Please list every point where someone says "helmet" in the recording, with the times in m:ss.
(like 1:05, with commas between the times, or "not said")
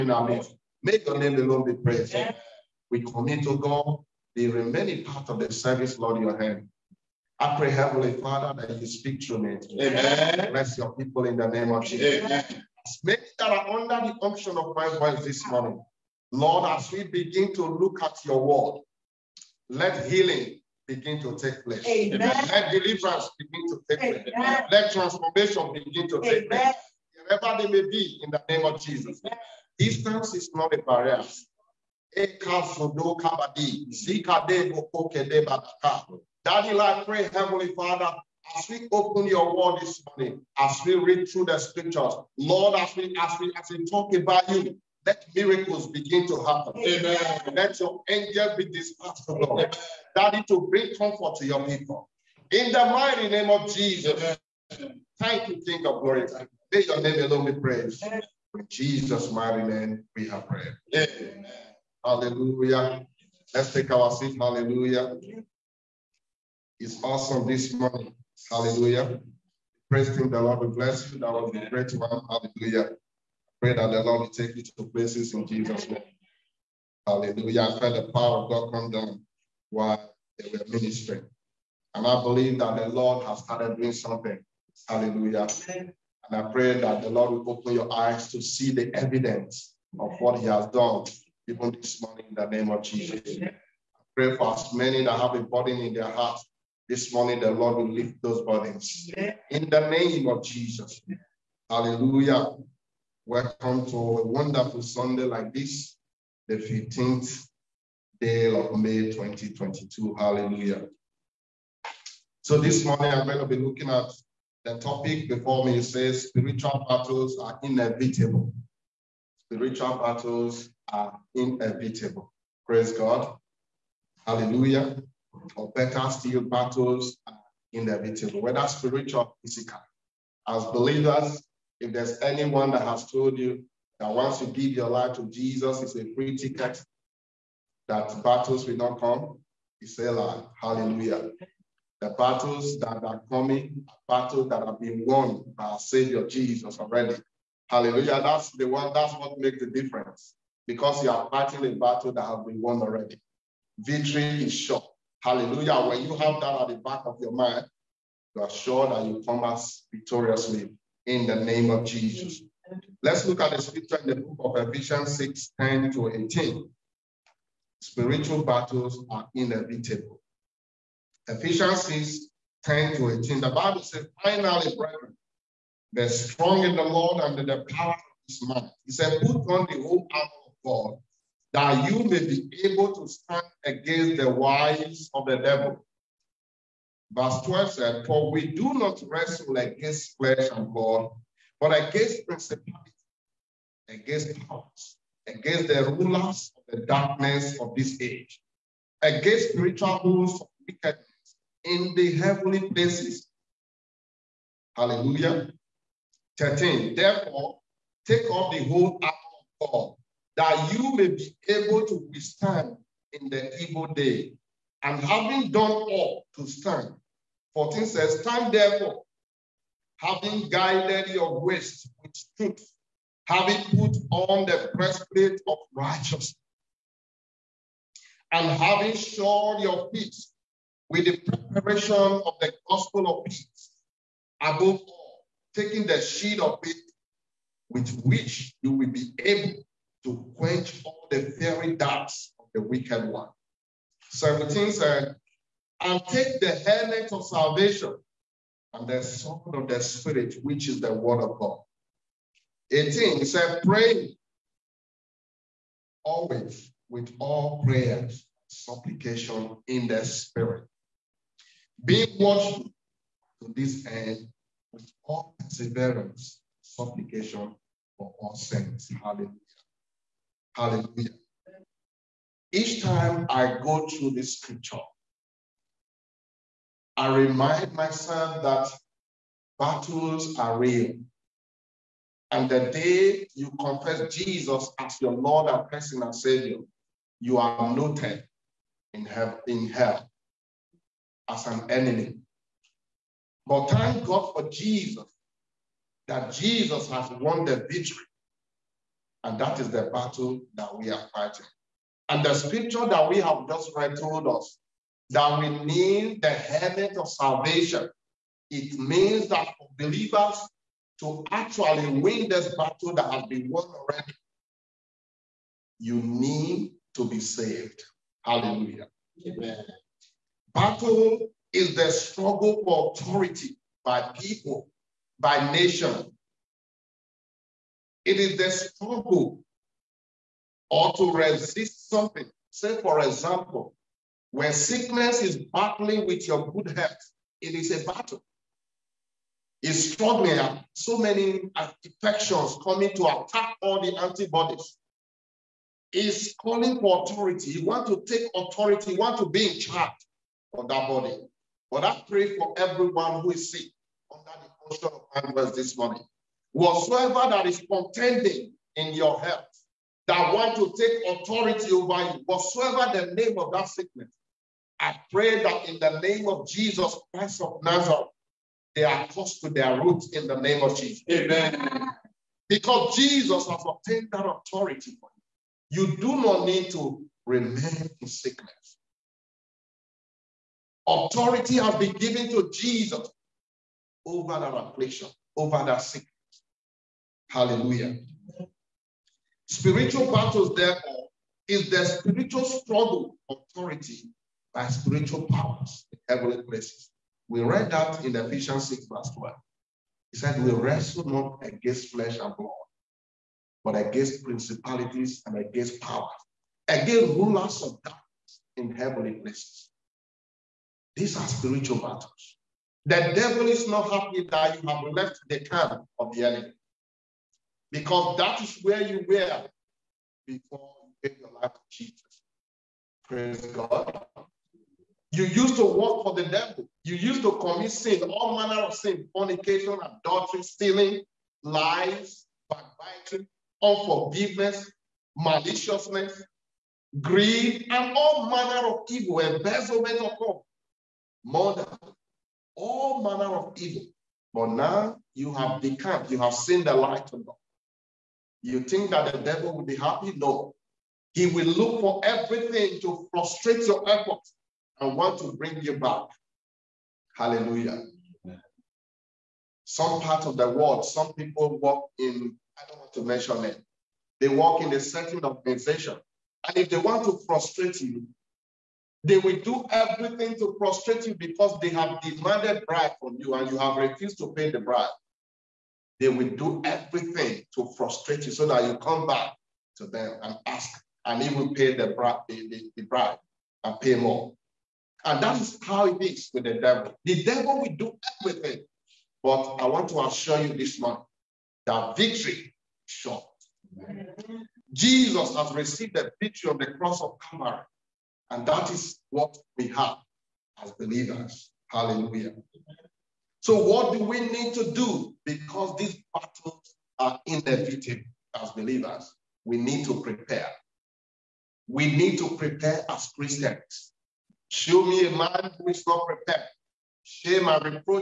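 4:06, 5:06.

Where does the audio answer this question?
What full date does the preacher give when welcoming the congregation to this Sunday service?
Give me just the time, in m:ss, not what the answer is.
1:46.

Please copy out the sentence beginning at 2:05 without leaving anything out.
Or better still, battles are inevitable, whether spiritual or physical.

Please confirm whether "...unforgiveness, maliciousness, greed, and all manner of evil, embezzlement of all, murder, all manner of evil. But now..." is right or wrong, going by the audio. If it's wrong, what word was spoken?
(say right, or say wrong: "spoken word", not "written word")
right.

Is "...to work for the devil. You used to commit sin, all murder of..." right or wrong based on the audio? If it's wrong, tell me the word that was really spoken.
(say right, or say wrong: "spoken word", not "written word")
wrong: "manner", not "murder".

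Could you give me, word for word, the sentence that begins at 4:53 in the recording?
But thank God for Jesus, that Jesus has won the victory and that is the battle that we are fighting.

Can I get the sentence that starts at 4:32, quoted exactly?
Each time I go through the scripture, I remind myself that battles are real.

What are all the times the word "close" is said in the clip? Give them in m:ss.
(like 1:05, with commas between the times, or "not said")
6:09.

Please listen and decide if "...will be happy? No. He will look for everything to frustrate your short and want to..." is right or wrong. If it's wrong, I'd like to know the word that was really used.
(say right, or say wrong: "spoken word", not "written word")
wrong: "effort", not "short".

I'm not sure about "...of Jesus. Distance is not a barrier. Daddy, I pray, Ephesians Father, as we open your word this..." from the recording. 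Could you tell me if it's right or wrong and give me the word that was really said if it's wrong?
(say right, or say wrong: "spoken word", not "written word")
wrong: "Heavenly", not "Ephesians".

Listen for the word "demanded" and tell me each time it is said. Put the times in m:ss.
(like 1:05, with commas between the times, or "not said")
7:52.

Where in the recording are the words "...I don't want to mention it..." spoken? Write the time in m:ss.
7:42.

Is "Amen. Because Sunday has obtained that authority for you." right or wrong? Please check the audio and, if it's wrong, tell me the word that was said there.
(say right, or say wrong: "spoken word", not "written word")
wrong: "Jesus", not "Sunday".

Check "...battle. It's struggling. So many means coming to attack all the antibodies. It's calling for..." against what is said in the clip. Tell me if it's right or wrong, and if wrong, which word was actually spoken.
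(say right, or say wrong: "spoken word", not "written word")
wrong: "infections", not "means".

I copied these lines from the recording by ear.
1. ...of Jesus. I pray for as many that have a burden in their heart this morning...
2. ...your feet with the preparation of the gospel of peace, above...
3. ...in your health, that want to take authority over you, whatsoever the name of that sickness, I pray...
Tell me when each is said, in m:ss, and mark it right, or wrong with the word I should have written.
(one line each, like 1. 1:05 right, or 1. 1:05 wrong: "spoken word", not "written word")
1. 1:32 right
2. 3:49 right
3. 5:58 right.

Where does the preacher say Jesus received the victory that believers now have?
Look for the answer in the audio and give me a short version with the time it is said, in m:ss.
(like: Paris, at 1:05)
cross of Calvary, at 8:16.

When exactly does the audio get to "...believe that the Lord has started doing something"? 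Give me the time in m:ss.
1:22.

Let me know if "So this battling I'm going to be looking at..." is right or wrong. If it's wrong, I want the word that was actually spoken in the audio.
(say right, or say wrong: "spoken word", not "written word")
wrong: "morning", not "battling".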